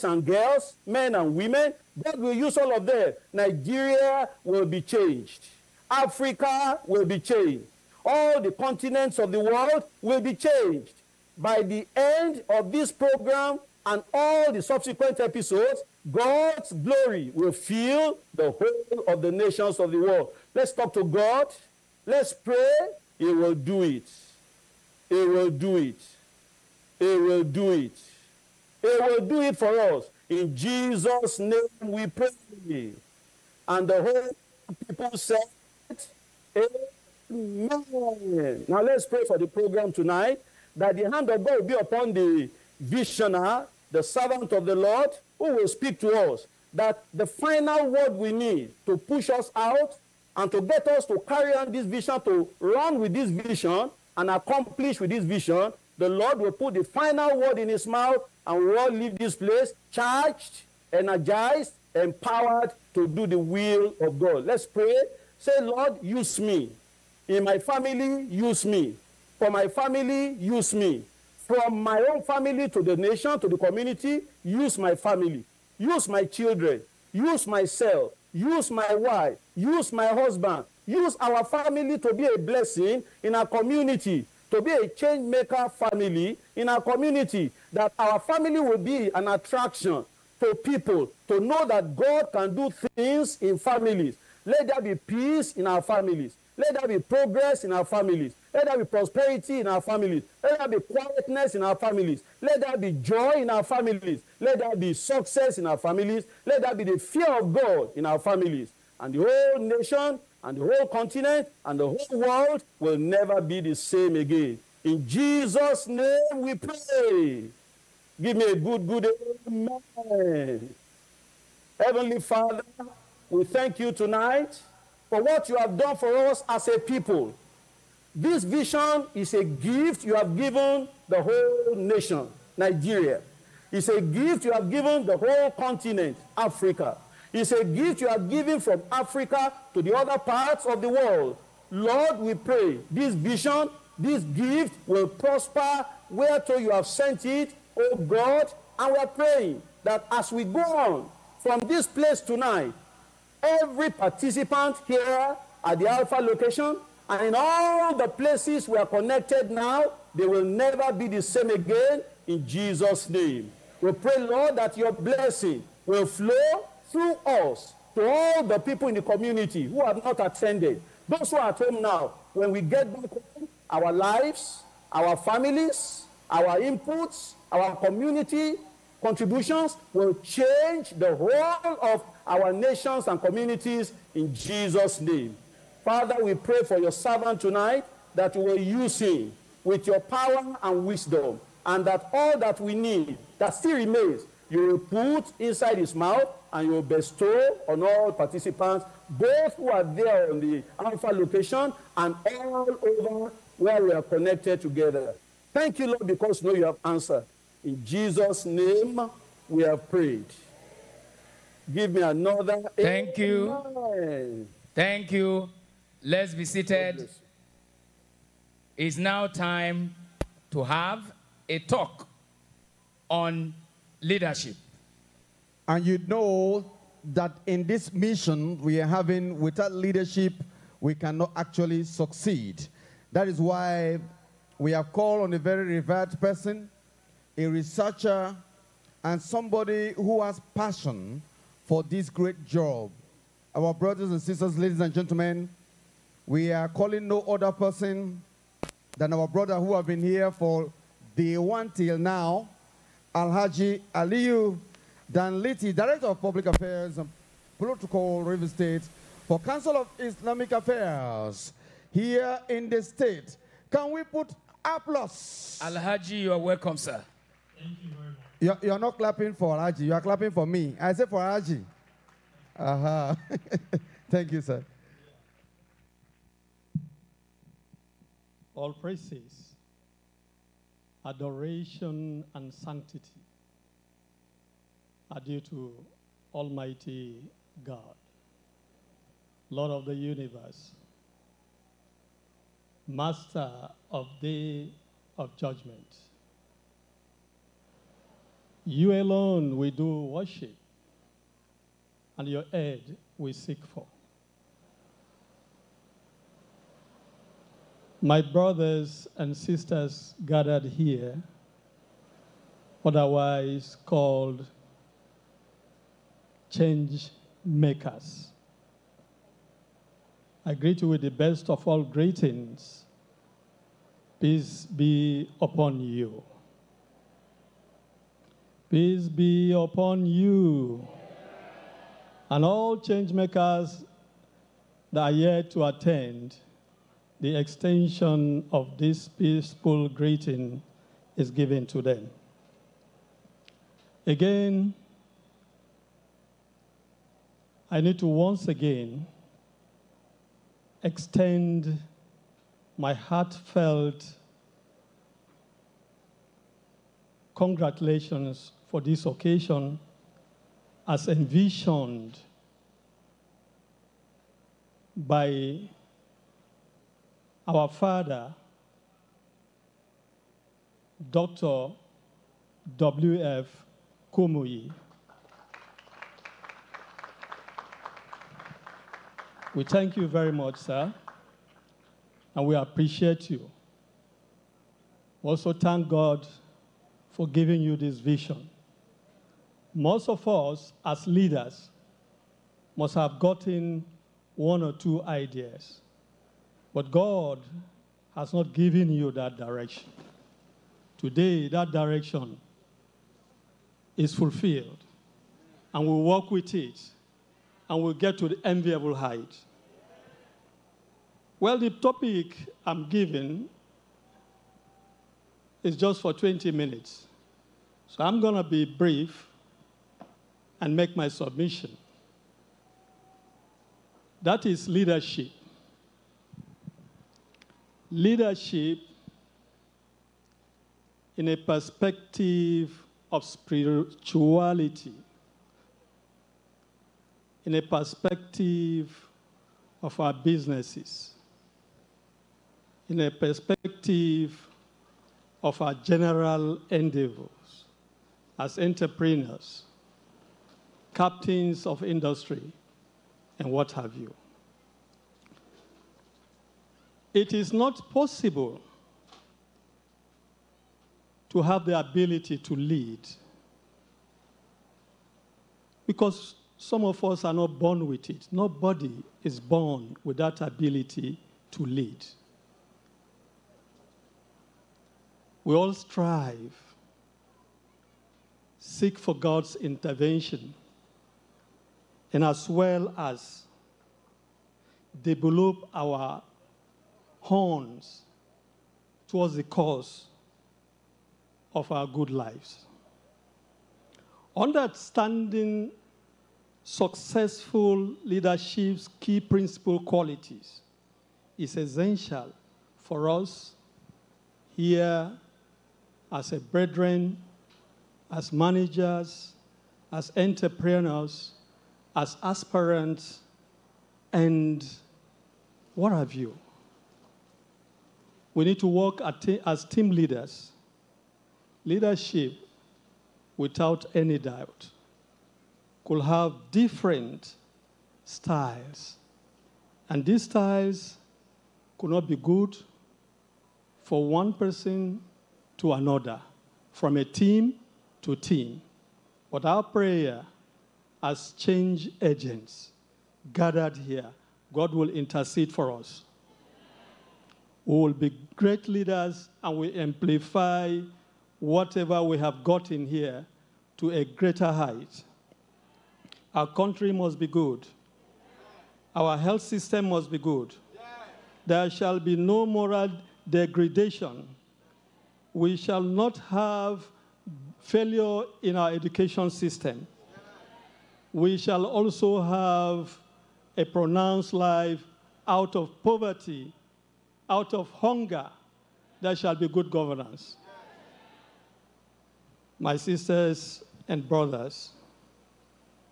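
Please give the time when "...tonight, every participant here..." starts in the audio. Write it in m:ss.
2:32.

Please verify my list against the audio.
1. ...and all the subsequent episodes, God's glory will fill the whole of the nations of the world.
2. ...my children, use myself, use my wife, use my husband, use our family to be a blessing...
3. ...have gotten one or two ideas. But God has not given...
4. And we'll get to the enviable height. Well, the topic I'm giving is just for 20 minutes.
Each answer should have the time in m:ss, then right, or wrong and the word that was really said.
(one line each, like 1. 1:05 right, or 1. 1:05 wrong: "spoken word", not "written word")
1. 0:13 right
2. 1:16 right
3. 6:32 right
4. 6:47 right.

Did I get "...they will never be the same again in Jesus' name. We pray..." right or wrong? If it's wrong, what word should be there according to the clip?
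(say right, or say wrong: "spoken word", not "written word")
right.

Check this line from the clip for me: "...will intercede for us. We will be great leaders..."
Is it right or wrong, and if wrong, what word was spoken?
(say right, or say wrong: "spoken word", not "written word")
right.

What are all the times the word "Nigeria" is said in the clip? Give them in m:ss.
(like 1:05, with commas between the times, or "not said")
0:03, 2:12.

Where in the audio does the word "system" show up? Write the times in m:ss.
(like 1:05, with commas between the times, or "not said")
9:19, 9:29.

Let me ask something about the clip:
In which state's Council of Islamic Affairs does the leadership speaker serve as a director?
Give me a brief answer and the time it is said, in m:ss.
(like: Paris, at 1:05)
River State, at 4:18.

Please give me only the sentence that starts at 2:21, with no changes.
Lord, we pray this vision, this gift will prosper to you have sent it, O God.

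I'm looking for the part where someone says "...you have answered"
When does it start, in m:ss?
3:26.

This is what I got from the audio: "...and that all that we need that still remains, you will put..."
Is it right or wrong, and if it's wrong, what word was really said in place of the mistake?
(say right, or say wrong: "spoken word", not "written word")
right.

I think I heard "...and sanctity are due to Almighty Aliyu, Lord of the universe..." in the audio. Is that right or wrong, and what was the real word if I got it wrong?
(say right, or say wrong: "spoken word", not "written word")
wrong: "God", not "Aliyu".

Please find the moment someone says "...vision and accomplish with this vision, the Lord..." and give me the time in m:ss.
0:53.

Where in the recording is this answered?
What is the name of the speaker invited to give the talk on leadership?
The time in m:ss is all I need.
4:13.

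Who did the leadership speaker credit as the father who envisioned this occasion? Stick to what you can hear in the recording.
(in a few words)
Dr. W.F. Kumuyi.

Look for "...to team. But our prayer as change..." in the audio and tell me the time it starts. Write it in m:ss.
8:58.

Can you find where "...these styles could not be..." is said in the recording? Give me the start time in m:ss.
8:50.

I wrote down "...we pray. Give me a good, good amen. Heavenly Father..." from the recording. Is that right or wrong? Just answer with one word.
right.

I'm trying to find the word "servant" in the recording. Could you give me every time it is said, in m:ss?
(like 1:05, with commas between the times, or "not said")
0:44, 3:06.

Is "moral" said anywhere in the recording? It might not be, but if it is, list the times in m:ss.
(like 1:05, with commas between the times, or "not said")
9:22.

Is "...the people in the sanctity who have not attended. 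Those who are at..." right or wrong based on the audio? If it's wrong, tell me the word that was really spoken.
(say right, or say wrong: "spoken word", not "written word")
wrong: "community", not "sanctity".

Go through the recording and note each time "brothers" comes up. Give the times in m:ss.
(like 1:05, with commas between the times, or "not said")
4:03, 4:09, 5:08, 9:44.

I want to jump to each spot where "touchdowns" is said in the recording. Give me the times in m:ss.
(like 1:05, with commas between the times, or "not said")
not said.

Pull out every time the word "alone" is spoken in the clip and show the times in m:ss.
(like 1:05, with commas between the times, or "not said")
4:58.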